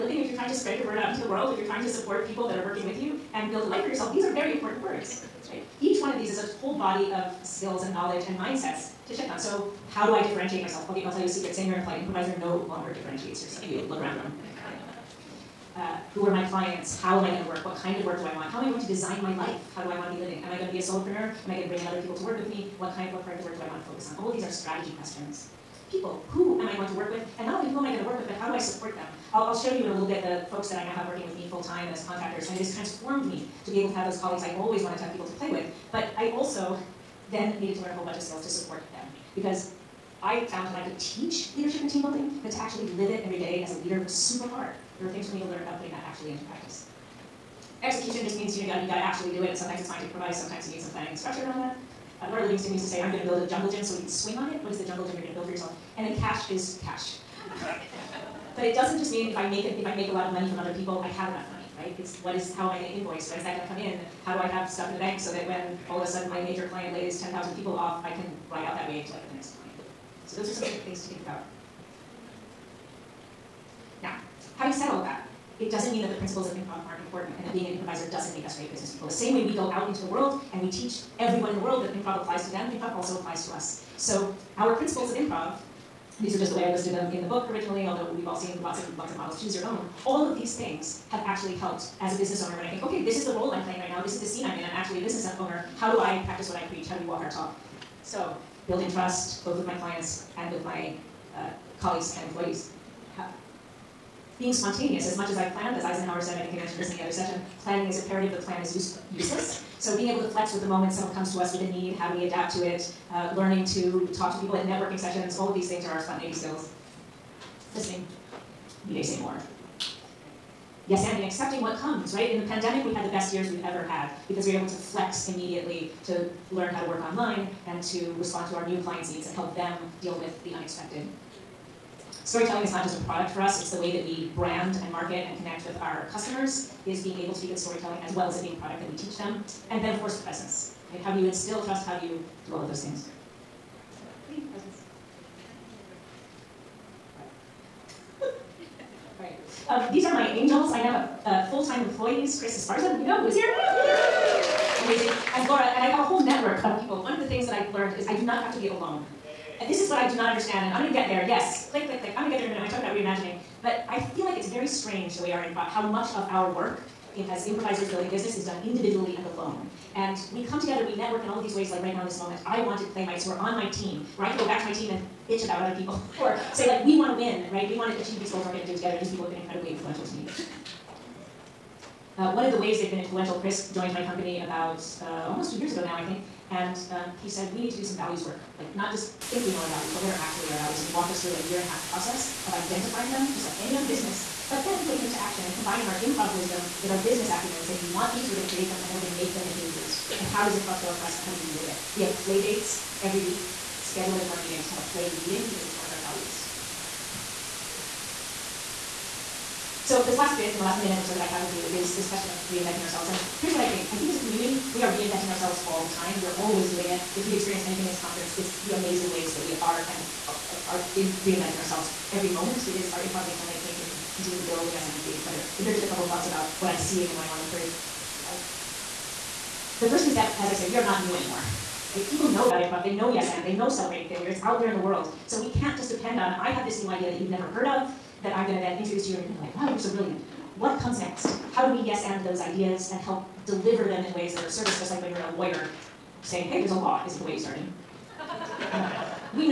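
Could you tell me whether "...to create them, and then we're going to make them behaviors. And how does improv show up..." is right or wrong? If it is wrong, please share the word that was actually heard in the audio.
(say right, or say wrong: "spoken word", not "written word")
right.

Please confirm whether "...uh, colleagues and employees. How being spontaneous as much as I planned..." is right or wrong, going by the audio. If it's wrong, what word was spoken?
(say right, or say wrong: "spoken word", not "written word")
right.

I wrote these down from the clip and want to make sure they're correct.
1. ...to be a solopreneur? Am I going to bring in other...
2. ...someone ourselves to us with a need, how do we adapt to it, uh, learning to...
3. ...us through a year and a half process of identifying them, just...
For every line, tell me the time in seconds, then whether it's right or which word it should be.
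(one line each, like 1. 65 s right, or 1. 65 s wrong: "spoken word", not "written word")
1. 20 s right
2. 110 s wrong: "comes", not "ourselves"
3. 191 s right.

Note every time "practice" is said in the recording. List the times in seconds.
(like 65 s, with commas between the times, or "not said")
46 s, 96 s.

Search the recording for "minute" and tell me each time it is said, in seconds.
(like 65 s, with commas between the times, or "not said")
162 s, 210 s.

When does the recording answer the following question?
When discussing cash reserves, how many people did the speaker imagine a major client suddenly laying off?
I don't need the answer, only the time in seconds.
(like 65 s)
67 s.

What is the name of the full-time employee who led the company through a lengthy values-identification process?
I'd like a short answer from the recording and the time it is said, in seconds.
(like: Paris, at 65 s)
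Chris Esparza, at 152 s.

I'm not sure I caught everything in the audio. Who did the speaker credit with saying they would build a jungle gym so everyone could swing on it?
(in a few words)
Laura Livingston.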